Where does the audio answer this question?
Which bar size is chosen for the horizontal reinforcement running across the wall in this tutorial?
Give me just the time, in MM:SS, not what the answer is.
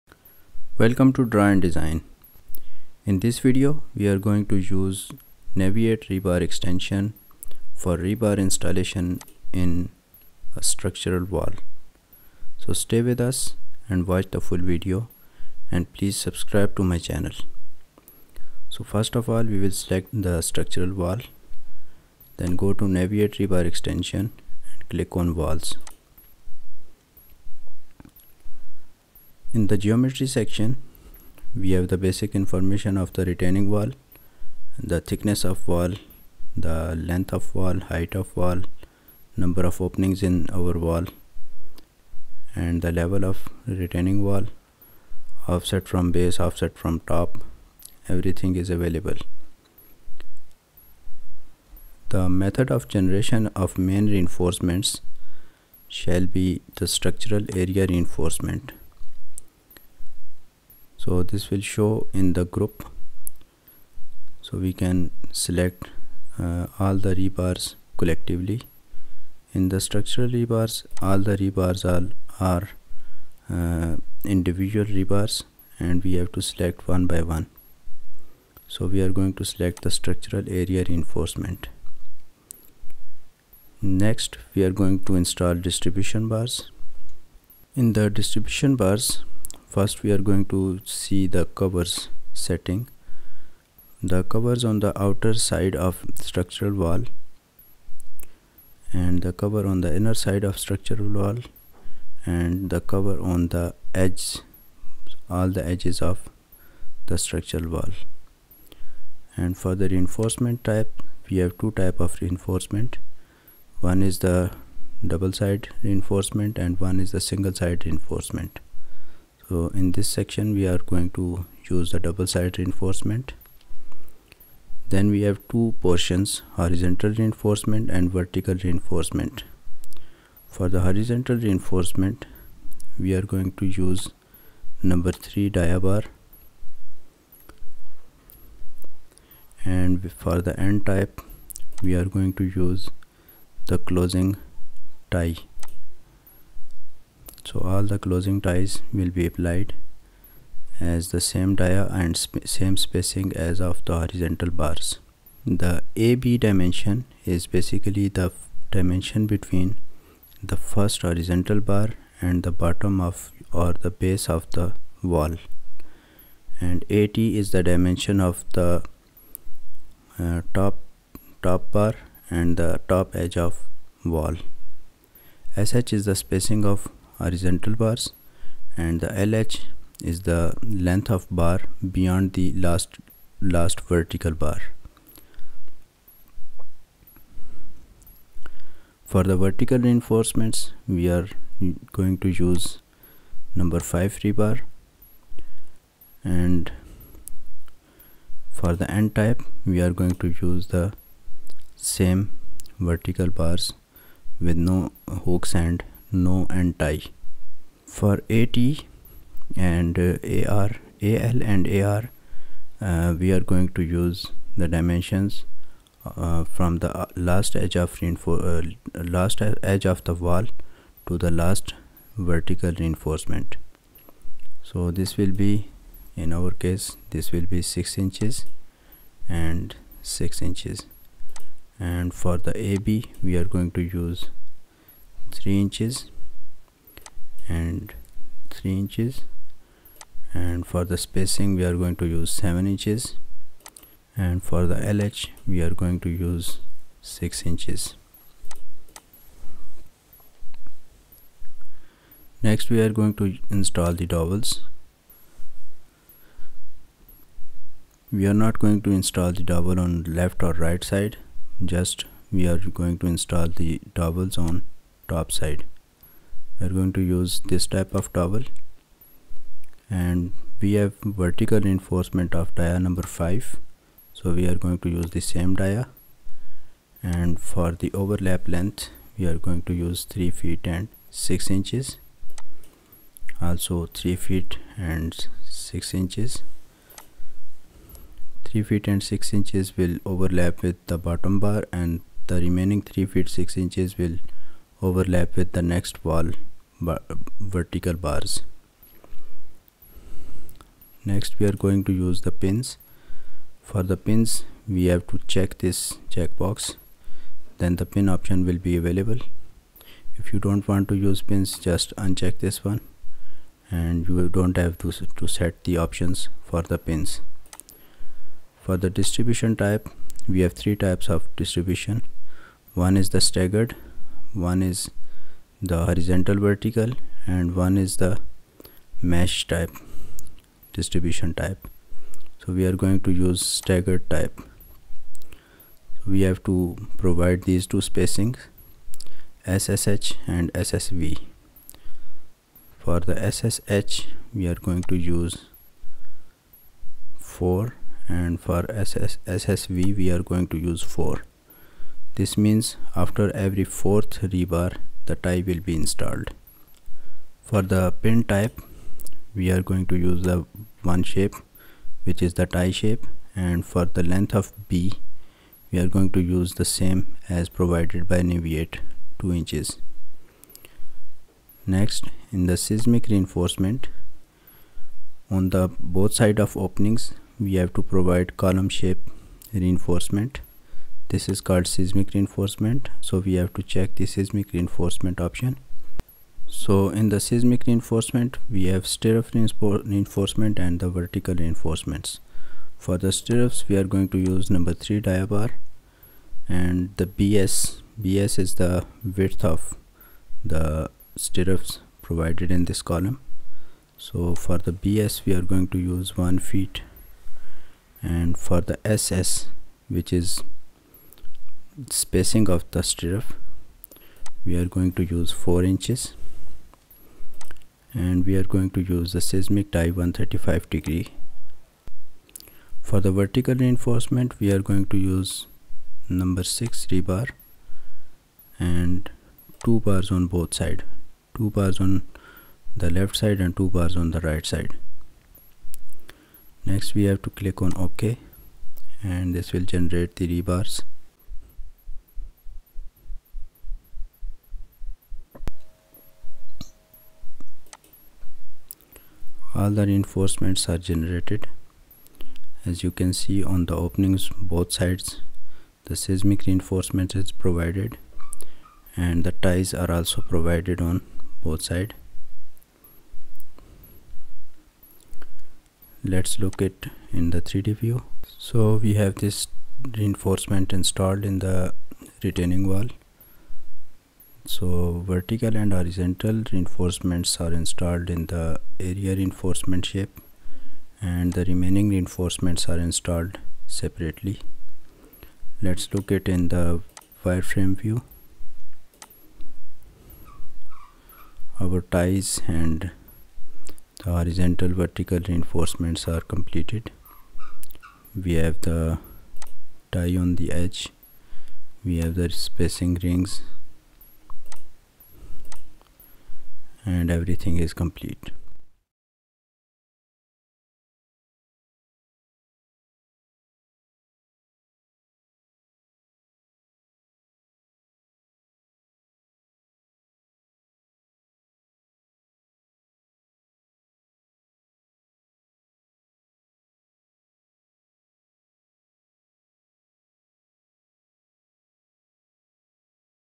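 02:14.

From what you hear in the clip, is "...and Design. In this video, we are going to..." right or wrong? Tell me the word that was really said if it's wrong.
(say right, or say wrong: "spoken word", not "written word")
right.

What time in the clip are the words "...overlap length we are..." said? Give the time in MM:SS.
04:38.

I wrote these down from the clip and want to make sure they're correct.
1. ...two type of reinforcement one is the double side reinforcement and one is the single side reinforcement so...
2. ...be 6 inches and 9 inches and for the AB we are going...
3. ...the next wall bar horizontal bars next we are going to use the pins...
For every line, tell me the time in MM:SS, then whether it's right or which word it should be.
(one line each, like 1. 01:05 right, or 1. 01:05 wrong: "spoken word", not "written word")
1. 01:51 right
2. 03:47 wrong: "6", not "9"
3. 04:55 wrong: "vertical", not "horizontal".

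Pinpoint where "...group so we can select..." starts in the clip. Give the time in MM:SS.
01:02.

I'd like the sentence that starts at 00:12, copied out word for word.
So stay with us and watch the full video and please subscribe to my channel.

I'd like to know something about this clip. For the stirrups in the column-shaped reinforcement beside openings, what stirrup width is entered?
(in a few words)
1 foot.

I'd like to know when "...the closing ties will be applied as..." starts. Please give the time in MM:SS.
02:27.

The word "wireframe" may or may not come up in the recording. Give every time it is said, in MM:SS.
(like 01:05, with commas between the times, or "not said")
08:07.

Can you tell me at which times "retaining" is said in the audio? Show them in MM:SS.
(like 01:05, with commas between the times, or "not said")
00:33, 00:43, 07:52.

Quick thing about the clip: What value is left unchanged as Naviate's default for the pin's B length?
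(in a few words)
2 inches.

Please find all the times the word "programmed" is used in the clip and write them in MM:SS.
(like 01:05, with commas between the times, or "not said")
not said.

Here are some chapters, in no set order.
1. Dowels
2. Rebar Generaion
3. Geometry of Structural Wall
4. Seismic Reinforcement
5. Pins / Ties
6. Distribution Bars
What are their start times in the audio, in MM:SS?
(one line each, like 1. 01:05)
1. 04:12
2. 07:17
3. 00:25
4. 06:13
5. 05:00
6. 01:24.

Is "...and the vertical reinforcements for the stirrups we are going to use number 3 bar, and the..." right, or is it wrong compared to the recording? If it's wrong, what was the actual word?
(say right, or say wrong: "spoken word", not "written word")
right.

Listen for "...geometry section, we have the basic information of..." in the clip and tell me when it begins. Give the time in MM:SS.
00:29.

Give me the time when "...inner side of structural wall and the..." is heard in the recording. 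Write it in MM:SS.
01:39.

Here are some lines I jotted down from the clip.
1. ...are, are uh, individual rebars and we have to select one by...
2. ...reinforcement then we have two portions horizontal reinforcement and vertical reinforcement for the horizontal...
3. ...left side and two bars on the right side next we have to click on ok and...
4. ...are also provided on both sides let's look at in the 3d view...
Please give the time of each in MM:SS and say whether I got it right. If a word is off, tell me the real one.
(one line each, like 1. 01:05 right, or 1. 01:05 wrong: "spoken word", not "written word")
1. 01:11 right
2. 02:02 right
3. 07:12 right
4. 07:39 right.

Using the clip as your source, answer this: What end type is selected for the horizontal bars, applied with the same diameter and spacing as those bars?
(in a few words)
closing tie.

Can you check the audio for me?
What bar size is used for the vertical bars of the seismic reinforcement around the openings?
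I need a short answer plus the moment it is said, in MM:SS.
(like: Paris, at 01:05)
number 6, at 07:06.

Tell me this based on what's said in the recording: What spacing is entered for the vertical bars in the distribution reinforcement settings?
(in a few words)
7 inches.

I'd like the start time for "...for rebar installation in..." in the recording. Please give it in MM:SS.
00:07.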